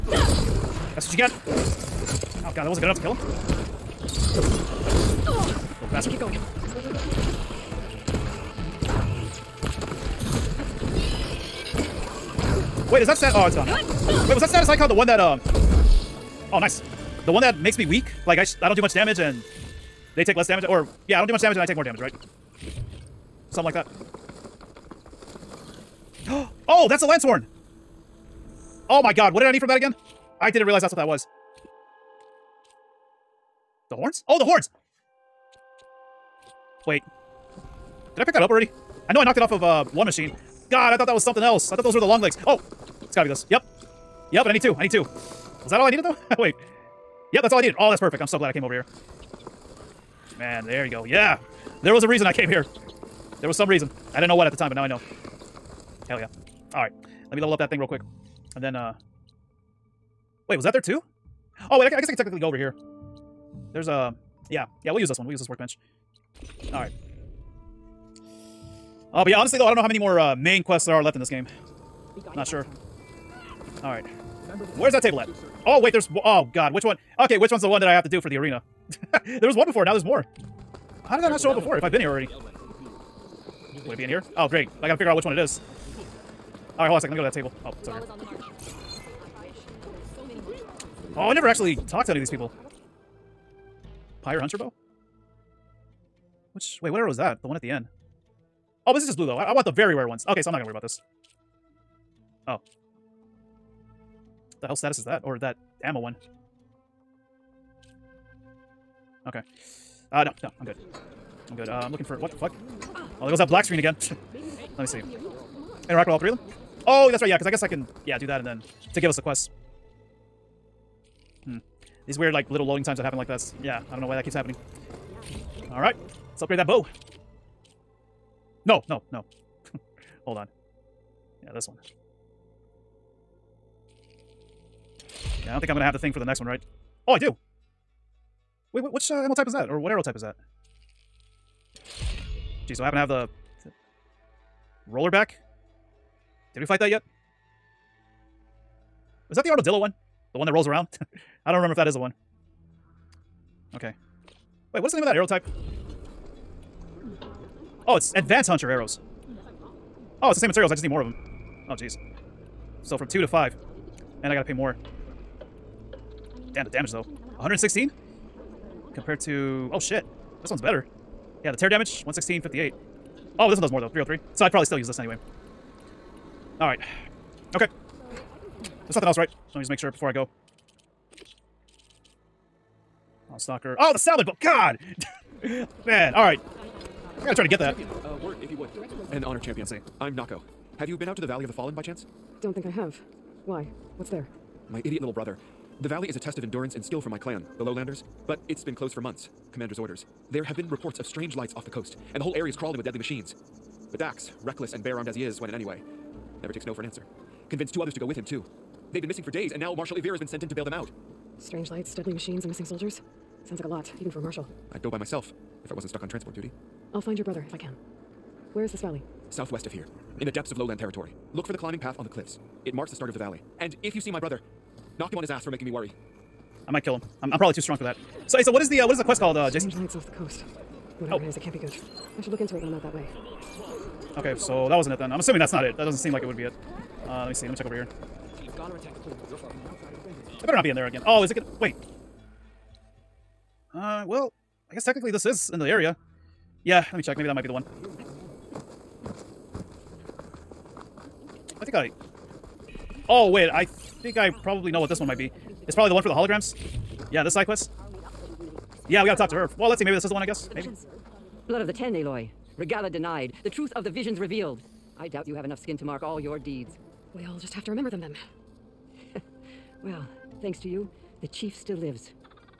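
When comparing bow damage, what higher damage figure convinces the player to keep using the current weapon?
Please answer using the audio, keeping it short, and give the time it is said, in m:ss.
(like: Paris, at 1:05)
303, at 2:53.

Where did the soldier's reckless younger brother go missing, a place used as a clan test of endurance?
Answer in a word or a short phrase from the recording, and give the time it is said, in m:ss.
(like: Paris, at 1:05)
Valley of the Fallen, at 3:11.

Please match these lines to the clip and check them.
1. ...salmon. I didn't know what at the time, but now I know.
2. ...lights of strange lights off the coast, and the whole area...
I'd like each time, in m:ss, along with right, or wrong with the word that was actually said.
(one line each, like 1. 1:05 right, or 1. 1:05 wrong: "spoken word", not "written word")
1. 0:53 wrong: "reason", not "salmon"
2. 3:20 wrong: "reports", not "lights".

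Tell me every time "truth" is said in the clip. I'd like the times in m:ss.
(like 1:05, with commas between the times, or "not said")
4:23.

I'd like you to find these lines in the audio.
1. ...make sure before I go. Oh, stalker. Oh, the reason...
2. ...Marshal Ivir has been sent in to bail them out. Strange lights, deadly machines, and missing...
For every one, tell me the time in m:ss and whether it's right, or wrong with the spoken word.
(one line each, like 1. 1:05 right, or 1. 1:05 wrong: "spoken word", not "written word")
1. 2:59 wrong: "salmon", not "reason"
2. 3:29 right.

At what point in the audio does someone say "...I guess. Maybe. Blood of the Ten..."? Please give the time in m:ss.
4:20.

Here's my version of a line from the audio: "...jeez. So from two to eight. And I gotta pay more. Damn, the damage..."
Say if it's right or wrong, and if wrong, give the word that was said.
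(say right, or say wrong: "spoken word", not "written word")
wrong: "five", not "eight".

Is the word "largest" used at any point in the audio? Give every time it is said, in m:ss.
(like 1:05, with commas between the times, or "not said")
not said.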